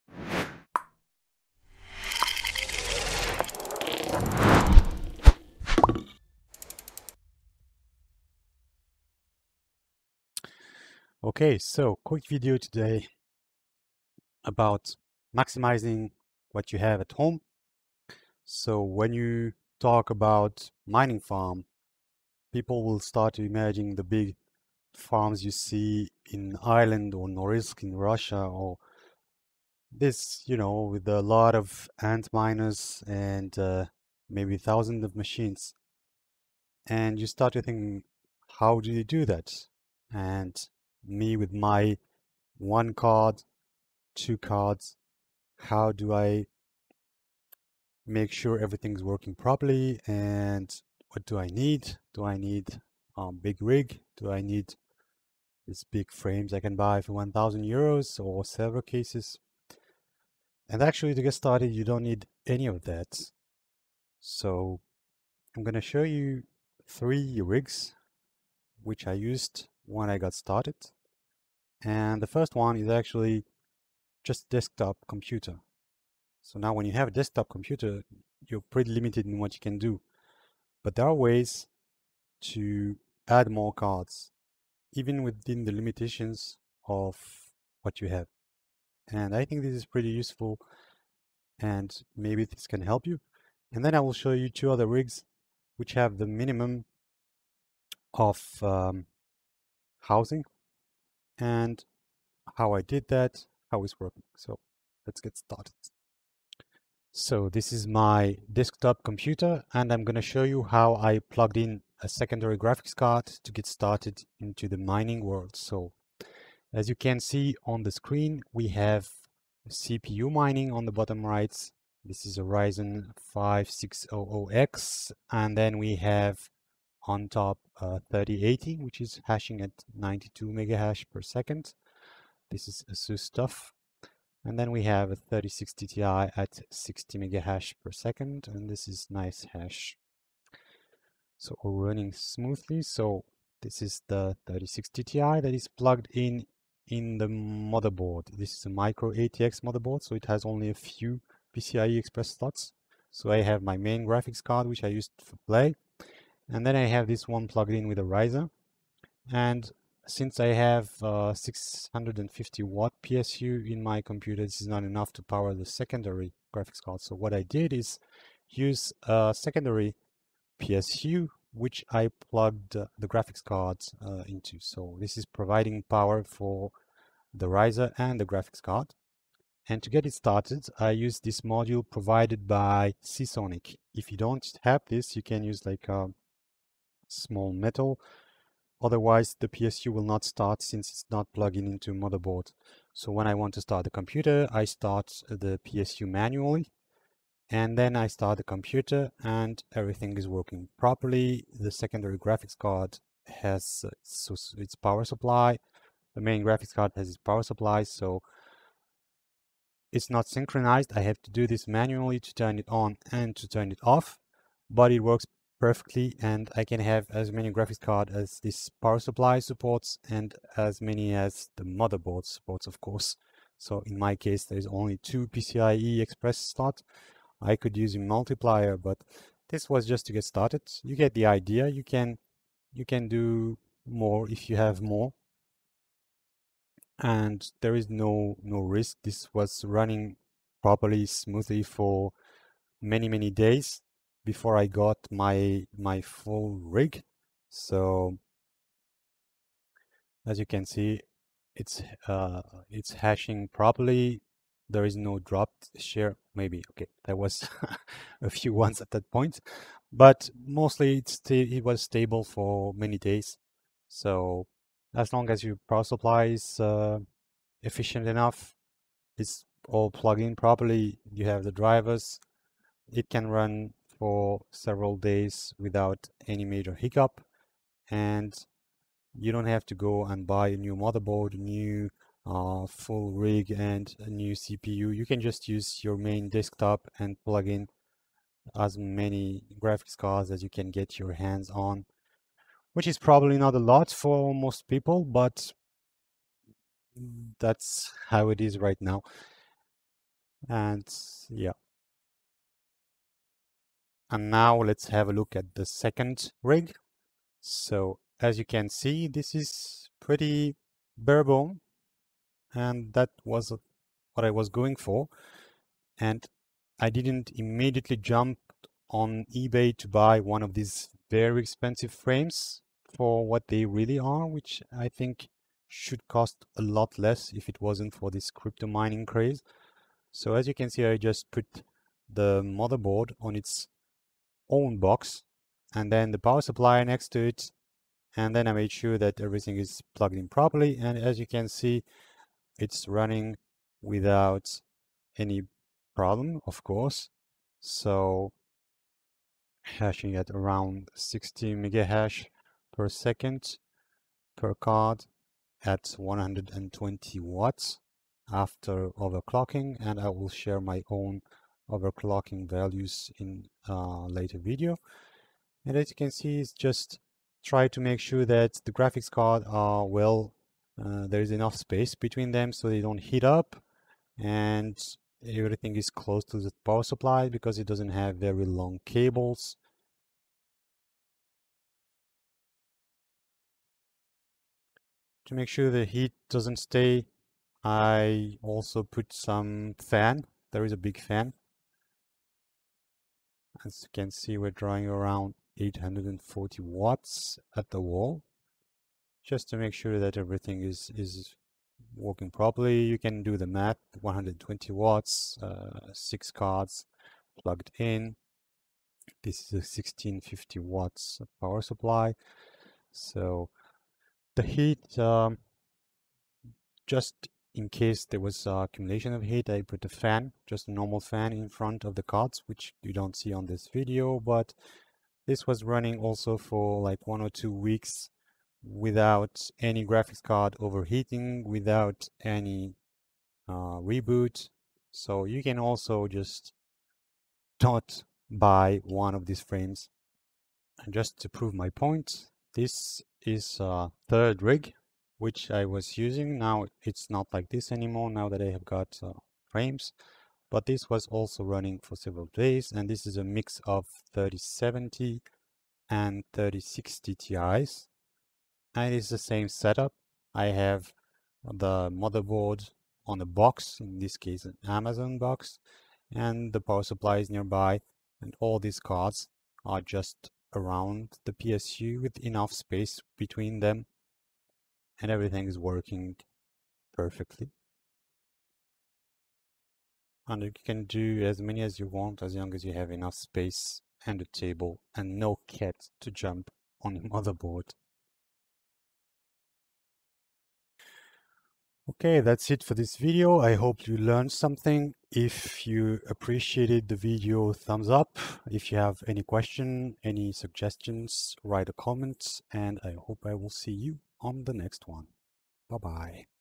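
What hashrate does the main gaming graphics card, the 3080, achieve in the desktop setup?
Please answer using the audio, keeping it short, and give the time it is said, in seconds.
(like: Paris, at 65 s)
92 megahash per second, at 129 s.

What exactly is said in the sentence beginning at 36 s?
And you start to think, how do you do that?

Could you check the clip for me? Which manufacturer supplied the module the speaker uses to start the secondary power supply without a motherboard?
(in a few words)
Seasonic.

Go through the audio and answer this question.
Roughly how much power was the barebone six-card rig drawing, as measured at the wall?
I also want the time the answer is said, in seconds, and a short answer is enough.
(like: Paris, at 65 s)
840 watts, at 395 s.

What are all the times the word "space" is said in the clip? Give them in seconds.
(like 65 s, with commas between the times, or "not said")
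371 s, 472 s, 483 s.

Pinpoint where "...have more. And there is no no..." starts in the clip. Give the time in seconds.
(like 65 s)
234 s.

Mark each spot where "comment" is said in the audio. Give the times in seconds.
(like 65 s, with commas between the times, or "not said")
501 s.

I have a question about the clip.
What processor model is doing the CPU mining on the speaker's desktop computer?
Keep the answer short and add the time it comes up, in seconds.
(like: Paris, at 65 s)
Ryzen 5600X, at 122 s.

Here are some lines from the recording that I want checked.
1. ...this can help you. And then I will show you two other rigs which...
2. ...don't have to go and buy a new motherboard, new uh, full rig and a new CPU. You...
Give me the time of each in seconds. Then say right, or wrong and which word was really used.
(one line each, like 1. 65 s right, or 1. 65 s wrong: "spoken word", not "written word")
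1. 92 s right
2. 279 s right.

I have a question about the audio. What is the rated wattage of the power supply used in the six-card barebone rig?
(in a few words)
1650 watts.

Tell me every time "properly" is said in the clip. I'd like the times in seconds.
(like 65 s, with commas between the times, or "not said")
49 s, 200 s, 240 s, 253 s, 270 s, 340 s, 402 s.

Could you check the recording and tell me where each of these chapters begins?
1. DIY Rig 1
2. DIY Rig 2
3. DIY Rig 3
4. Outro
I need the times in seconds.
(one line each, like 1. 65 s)
1. 106 s
2. 304 s
3. 440 s
4. 491 s.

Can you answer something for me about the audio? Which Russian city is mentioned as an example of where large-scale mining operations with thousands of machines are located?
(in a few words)
Norilsk.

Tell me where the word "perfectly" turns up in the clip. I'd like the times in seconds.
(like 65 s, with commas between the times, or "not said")
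215 s, 476 s.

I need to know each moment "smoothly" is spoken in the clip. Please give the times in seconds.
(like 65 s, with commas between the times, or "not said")
142 s, 241 s.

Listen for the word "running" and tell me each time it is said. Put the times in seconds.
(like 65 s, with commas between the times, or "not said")
141 s, 239 s, 342 s, 425 s, 451 s.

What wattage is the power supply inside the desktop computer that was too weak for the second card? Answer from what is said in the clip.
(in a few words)
650 watt.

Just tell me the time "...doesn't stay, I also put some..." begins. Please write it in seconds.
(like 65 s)
386 s.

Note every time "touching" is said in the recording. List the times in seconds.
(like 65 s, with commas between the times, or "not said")
not said.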